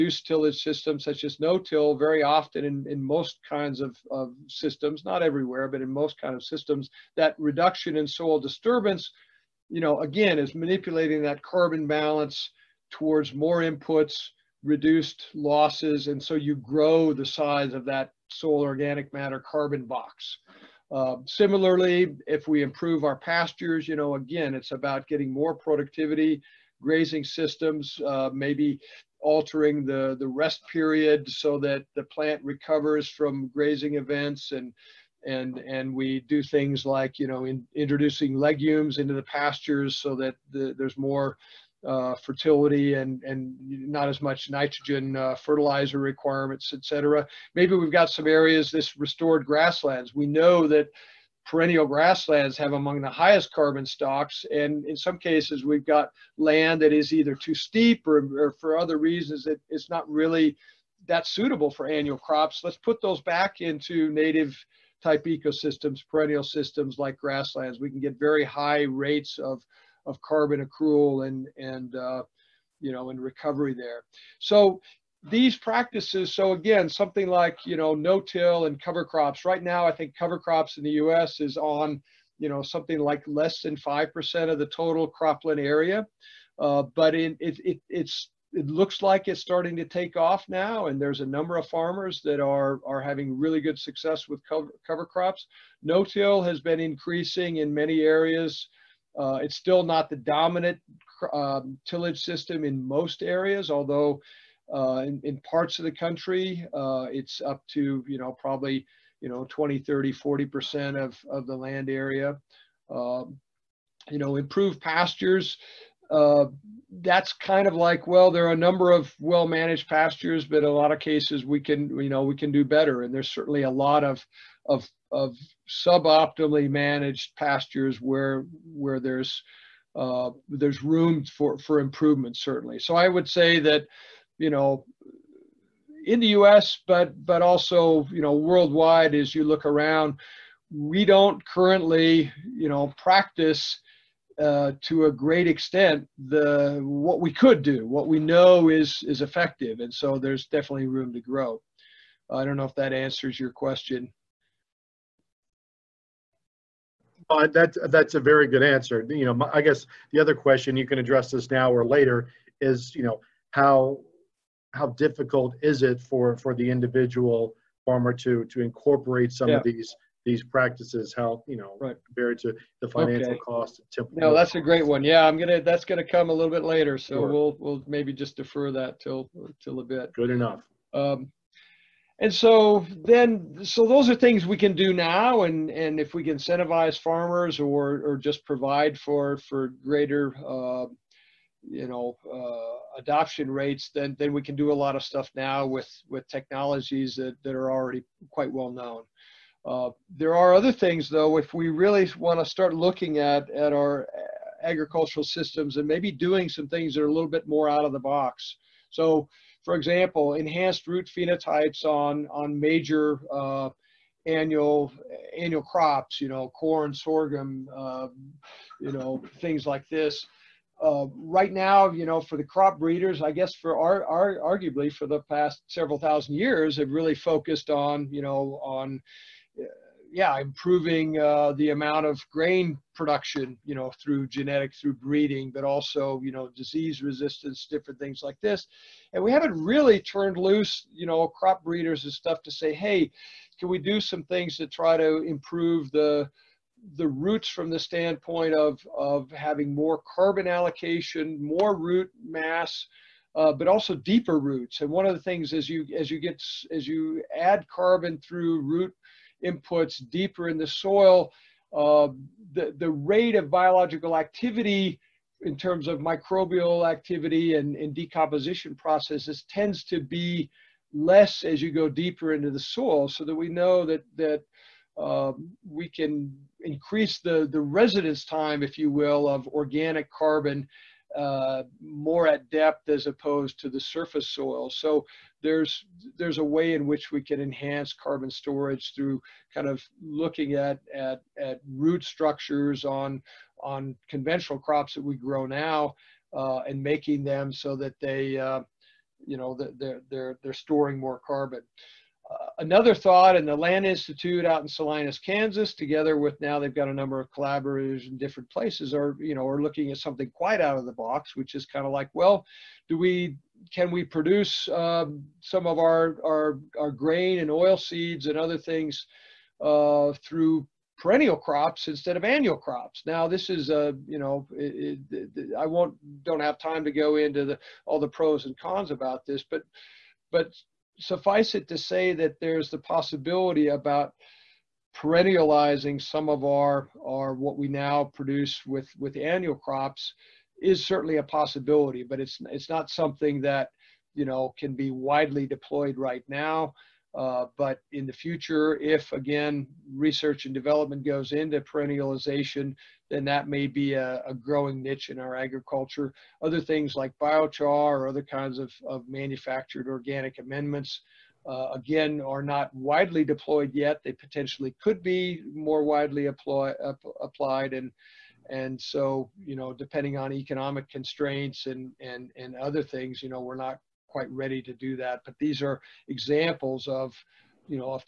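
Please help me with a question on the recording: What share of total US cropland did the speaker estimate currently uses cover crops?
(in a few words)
less than 5%.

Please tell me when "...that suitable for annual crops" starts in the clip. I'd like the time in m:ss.
1:01.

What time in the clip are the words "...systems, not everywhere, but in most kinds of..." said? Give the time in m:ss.
0:04.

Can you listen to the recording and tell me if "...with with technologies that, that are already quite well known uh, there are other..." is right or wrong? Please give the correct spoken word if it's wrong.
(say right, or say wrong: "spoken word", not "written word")
right.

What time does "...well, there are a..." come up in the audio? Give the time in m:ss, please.
1:58.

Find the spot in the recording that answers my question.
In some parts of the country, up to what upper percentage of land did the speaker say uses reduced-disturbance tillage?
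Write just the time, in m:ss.
1:50.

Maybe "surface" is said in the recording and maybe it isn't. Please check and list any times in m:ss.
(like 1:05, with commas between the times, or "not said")
4:43.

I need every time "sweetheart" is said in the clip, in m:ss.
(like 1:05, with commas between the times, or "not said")
not said.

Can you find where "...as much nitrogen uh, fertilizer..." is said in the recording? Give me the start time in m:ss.
0:44.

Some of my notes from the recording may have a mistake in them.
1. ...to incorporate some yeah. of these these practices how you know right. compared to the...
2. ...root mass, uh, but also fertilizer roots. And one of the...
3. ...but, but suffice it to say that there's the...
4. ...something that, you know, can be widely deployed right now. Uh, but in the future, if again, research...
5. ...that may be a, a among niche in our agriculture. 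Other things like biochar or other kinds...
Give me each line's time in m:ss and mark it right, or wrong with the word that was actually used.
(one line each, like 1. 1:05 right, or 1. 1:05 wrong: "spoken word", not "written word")
1. 2:48 right
2. 4:11 wrong: "deeper", not "fertilizer"
3. 5:29 right
4. 5:42 right
5. 5:53 wrong: "growing", not "among".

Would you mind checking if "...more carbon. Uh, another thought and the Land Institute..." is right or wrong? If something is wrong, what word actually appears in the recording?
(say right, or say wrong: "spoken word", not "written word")
right.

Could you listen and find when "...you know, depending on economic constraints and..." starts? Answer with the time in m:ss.
6:09.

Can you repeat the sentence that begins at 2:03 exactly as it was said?
And there's certainly a lot of, of, of suboptimally managed pastures where, where there's, uh, there's room for, for improvement, certainly.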